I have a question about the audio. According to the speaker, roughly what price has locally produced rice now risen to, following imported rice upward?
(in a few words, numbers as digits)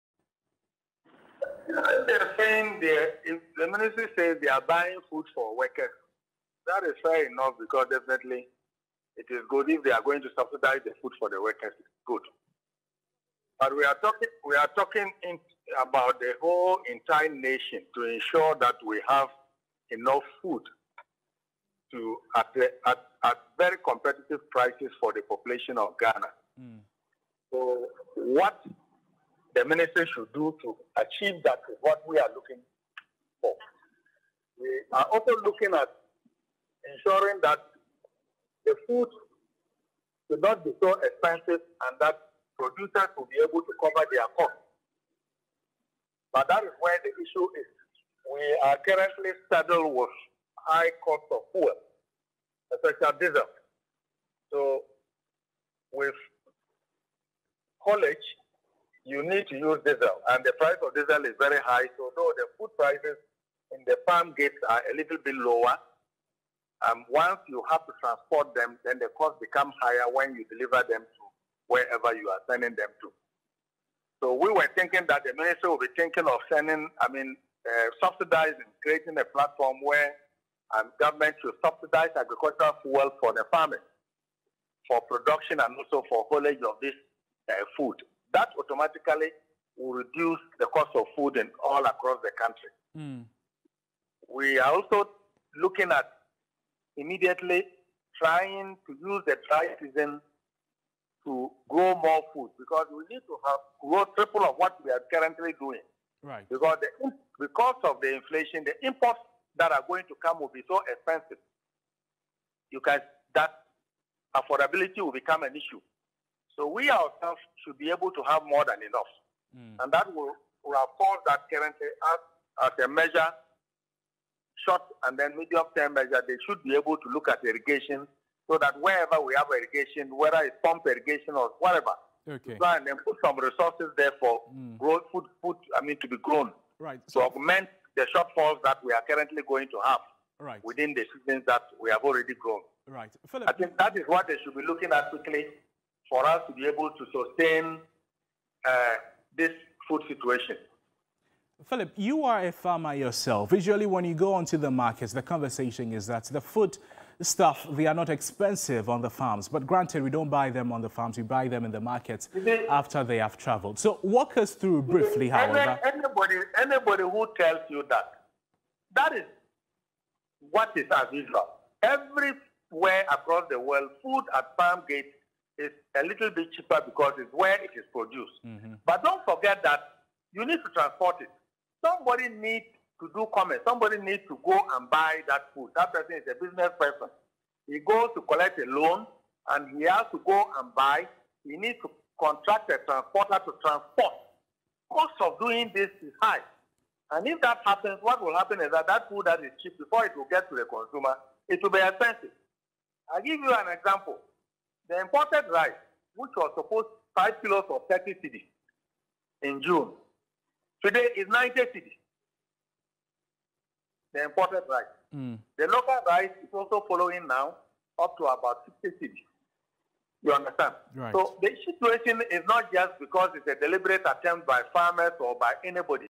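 60 cedi.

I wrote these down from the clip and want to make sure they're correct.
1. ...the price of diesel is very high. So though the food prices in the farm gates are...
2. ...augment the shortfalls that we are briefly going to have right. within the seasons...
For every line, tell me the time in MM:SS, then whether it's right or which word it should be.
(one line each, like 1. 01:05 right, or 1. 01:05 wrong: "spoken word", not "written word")
1. 01:00 right
2. 02:17 wrong: "currently", not "briefly".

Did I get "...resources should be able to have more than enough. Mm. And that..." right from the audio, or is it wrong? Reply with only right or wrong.
wrong.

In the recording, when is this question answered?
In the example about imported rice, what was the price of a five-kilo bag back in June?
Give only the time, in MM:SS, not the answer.
03:27.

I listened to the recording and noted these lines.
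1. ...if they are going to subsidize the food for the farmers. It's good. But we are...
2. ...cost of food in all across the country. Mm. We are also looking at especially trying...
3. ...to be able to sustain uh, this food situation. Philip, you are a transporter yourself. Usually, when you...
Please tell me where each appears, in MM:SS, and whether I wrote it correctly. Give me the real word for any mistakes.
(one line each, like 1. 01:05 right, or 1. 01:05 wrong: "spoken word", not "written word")
1. 00:09 wrong: "workers", not "farmers"
2. 01:30 wrong: "immediately", not "especially"
3. 02:26 wrong: "farmer", not "transporter".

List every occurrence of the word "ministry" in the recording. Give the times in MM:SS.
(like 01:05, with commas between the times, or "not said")
00:03, 00:29, 01:15.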